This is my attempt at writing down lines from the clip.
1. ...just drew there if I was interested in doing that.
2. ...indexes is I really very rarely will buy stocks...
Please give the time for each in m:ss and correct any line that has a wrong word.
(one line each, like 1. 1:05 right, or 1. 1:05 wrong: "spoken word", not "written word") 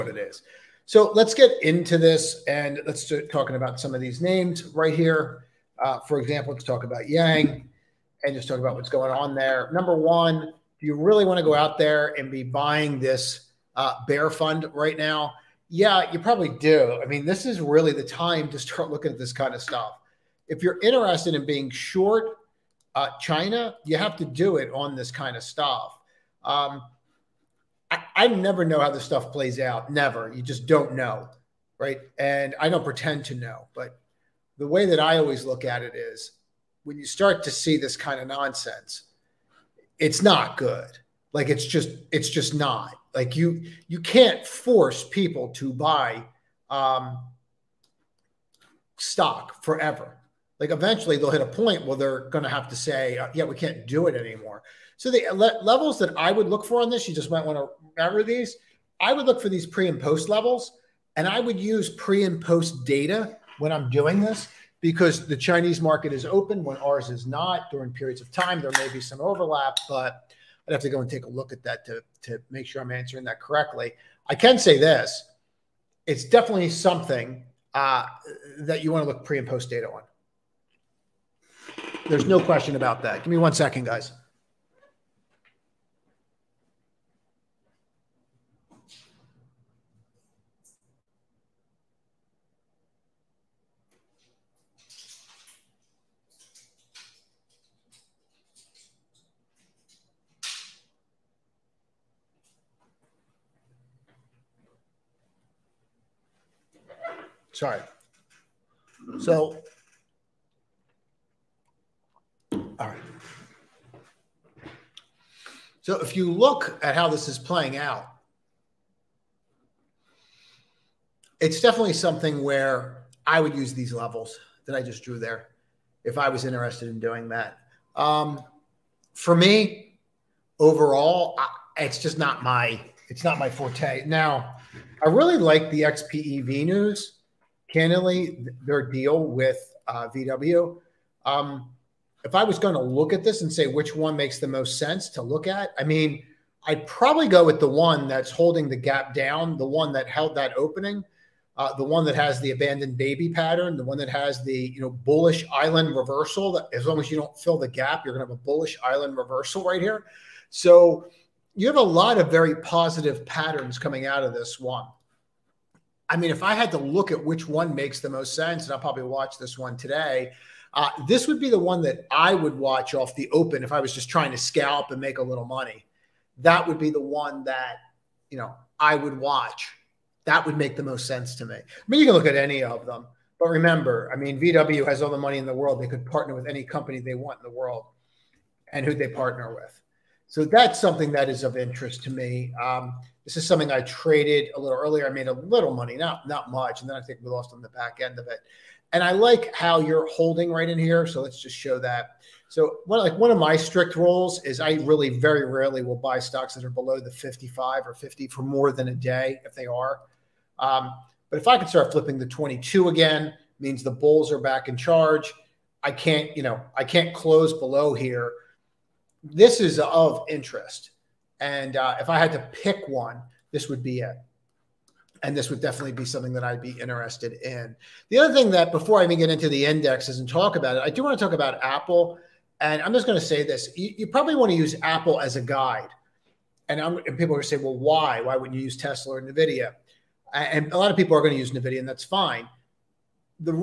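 1. 2:04 right
2. 3:23 wrong: "rules", not "indexes".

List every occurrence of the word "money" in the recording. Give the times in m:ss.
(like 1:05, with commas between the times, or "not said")
2:55, 3:05, 3:15.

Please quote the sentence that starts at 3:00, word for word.
That would make the most sense to me.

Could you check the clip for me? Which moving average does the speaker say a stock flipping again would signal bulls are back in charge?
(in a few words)
22.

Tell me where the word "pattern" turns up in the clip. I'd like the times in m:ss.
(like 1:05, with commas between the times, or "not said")
2:33, 2:43.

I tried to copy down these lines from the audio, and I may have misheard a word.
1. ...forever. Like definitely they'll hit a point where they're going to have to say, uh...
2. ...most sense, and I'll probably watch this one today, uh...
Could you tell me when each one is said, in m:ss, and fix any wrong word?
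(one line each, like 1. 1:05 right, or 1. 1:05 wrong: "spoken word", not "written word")
1. 0:49 wrong: "eventually", not "definitely"
2. 2:48 right.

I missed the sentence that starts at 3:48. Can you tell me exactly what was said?
The other thing that, before I even get into the indexes and talk about it, I do want to talk about Apple.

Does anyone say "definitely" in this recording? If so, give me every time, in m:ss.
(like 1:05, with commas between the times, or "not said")
1:16, 2:01, 3:45.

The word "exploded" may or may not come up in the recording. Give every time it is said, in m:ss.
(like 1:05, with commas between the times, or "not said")
not said.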